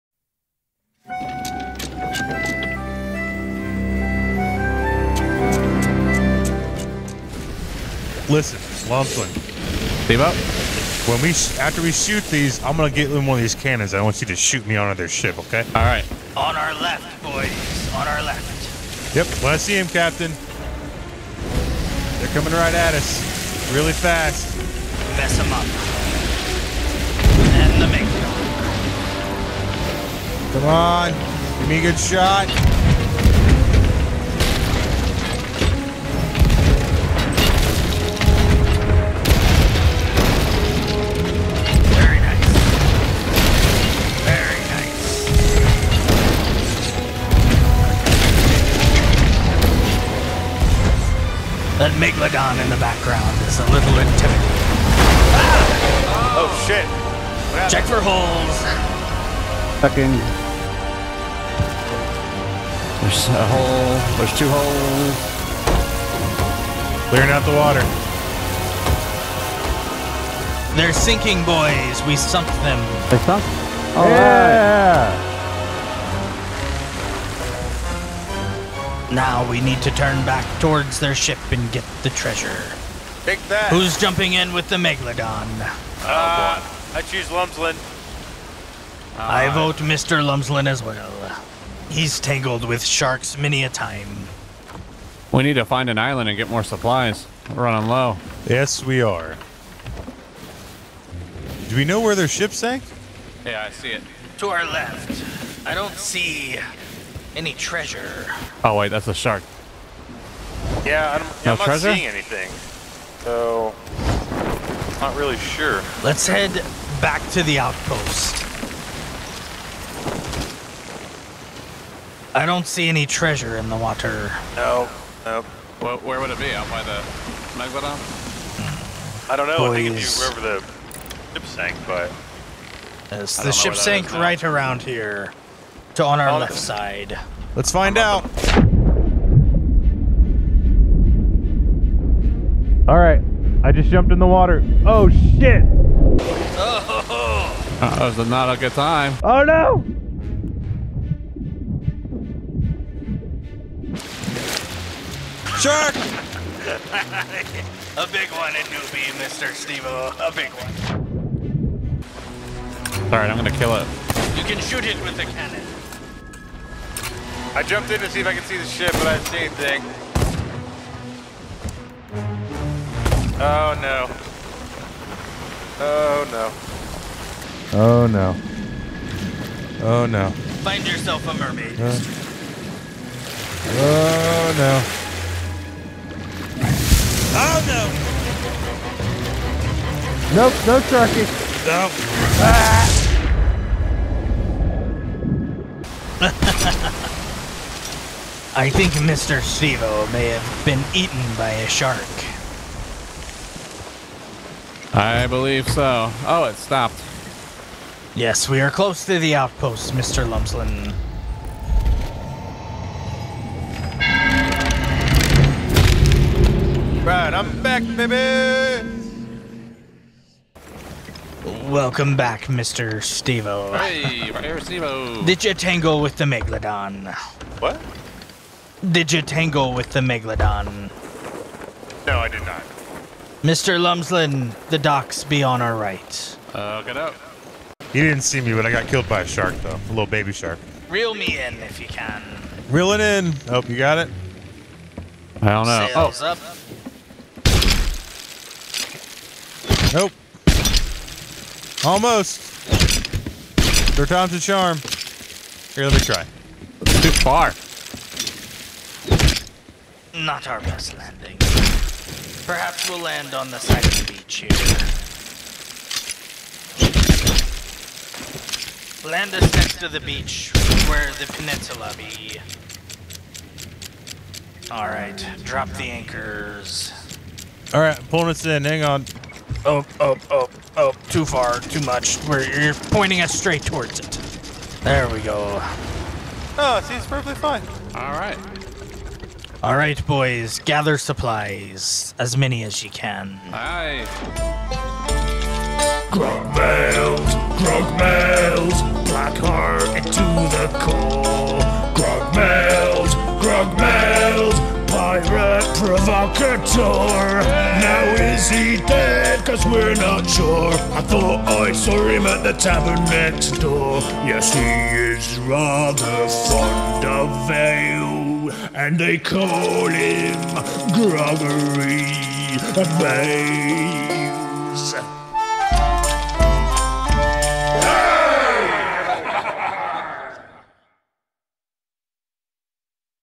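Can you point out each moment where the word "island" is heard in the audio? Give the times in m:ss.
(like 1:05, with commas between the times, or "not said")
1:35.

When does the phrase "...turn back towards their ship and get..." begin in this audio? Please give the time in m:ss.
1:19.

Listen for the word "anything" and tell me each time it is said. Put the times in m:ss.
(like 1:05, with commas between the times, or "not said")
1:52, 2:49.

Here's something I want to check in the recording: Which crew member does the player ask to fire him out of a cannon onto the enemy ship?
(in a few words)
Lumpkin.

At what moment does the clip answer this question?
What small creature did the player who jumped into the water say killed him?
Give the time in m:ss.
3:59.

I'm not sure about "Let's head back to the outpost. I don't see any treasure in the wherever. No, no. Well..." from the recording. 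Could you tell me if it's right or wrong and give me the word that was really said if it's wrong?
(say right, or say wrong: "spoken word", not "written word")
wrong: "water", not "wherever".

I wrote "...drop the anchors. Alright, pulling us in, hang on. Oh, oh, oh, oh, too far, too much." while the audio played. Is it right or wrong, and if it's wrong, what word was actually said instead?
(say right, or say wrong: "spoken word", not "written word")
right.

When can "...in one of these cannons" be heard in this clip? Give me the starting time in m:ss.
0:13.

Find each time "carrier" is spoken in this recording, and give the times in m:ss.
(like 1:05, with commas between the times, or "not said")
not said.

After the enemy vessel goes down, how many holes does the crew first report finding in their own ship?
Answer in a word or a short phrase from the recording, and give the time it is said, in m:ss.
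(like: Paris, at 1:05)
2, at 1:04.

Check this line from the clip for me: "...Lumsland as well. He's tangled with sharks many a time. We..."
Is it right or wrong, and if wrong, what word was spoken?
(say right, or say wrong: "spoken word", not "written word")
right.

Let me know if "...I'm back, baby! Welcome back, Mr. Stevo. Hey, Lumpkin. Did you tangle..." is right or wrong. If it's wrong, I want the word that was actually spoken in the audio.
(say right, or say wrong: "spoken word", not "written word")
wrong: "Stevo", not "Lumpkin".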